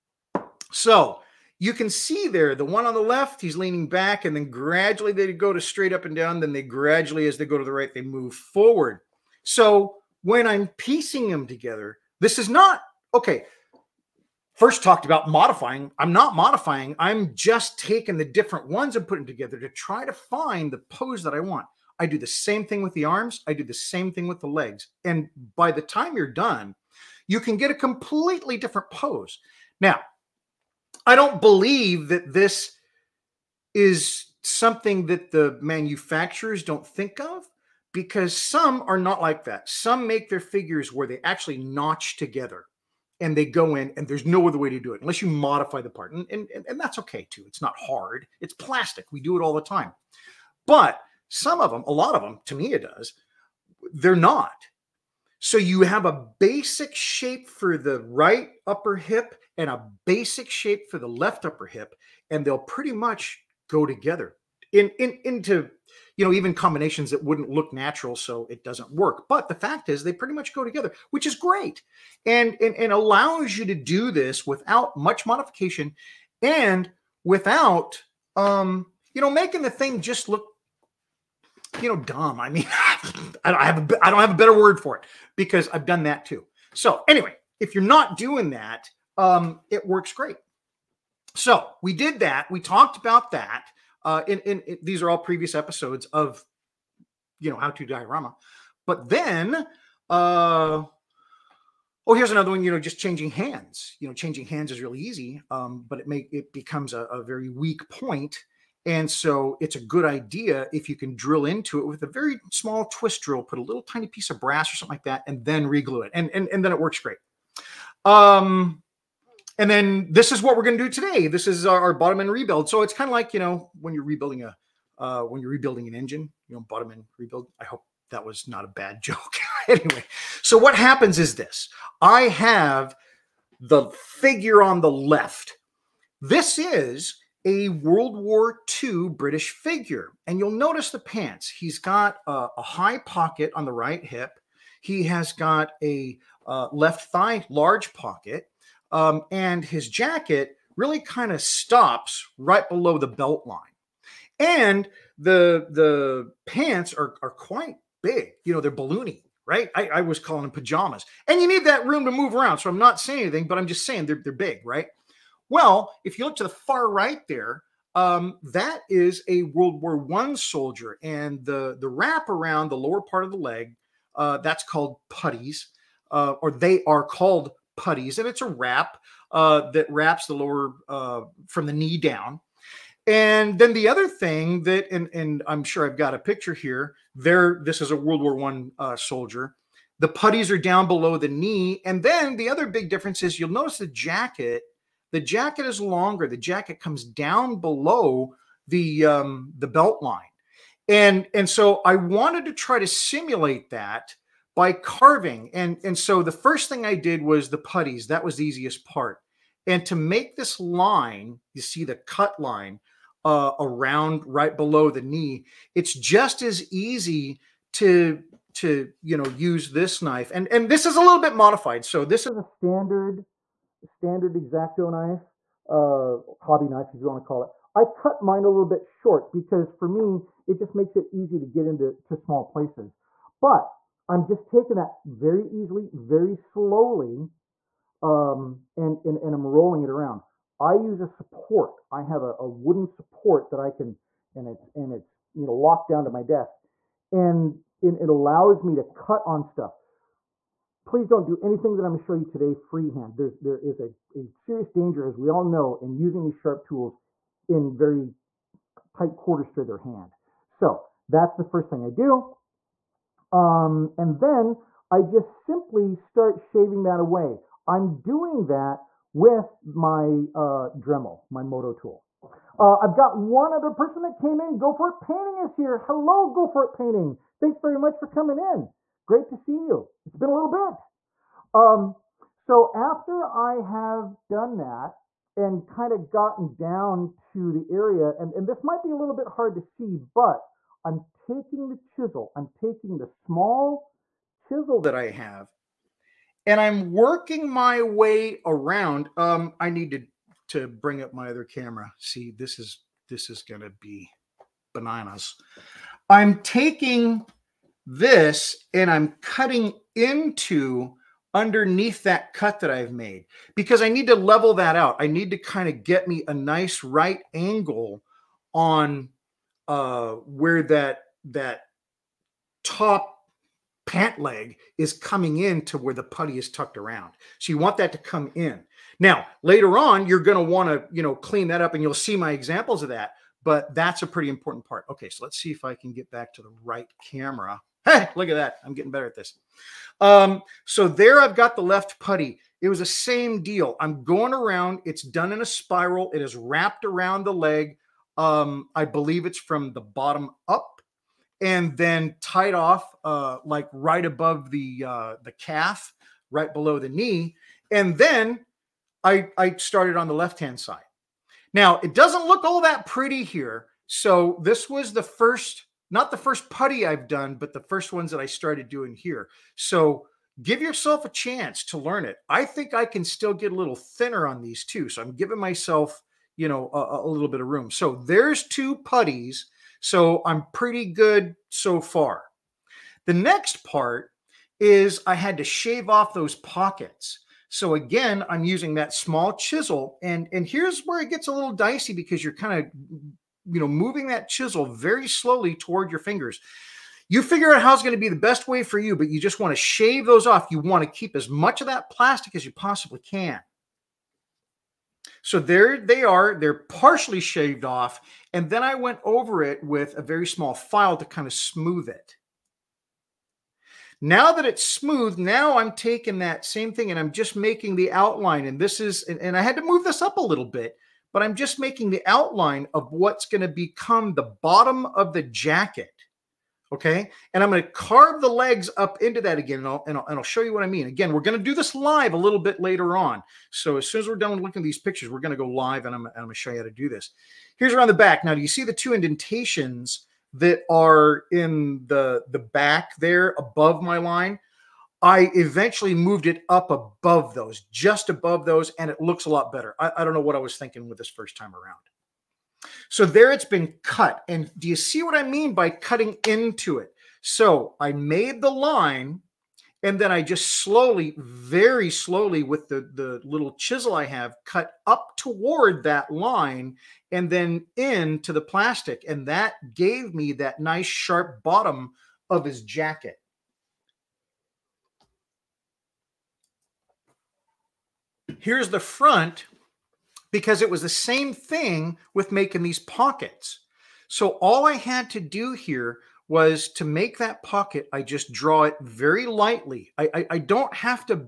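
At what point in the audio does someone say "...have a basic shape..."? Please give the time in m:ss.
0:55.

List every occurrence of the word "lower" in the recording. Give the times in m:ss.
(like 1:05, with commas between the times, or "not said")
2:52, 3:00.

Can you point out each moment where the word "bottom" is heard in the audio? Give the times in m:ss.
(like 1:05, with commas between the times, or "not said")
2:01, 2:06, 5:49, 7:04, 7:51.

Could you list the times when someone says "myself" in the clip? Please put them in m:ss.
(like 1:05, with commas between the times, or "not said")
6:15.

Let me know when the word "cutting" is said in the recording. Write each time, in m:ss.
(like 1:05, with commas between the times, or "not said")
5:09, 7:35.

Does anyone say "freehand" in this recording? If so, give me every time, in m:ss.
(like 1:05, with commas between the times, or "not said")
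4:12.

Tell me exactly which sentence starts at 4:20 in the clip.
So that's the first thing I do.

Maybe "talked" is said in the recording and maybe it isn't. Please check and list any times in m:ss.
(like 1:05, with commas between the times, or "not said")
0:14, 1:32.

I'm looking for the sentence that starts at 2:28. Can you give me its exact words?
Um, and his jacket really kind of stops right below the belt line.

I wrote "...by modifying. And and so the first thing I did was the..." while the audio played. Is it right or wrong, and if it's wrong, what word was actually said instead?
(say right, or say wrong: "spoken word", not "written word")
wrong: "carving", not "modifying".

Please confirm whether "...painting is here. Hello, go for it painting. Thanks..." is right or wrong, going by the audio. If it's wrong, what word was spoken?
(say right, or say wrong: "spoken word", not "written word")
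right.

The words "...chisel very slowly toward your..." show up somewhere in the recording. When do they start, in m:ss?
6:34.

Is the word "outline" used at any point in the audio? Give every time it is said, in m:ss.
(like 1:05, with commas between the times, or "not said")
6:57, 7:02.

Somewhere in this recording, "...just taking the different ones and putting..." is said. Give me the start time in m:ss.
0:17.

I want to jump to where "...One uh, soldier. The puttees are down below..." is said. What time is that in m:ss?
3:08.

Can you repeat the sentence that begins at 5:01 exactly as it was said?
See, this is this is gonna be bananas.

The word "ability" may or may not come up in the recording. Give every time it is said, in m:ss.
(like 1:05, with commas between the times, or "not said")
not said.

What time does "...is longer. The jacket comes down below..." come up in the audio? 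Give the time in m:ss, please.
3:15.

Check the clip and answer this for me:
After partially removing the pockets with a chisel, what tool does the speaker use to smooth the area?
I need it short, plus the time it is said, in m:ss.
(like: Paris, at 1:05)
small file, at 6:50.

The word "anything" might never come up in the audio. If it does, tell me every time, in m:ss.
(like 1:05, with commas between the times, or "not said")
2:43, 4:11.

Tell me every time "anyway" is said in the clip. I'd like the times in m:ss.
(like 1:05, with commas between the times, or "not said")
1:27, 2:09.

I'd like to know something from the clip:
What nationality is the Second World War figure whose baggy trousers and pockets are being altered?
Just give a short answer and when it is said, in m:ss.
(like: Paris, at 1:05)
British, at 2:19.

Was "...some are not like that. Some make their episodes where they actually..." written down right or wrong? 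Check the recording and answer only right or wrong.
wrong.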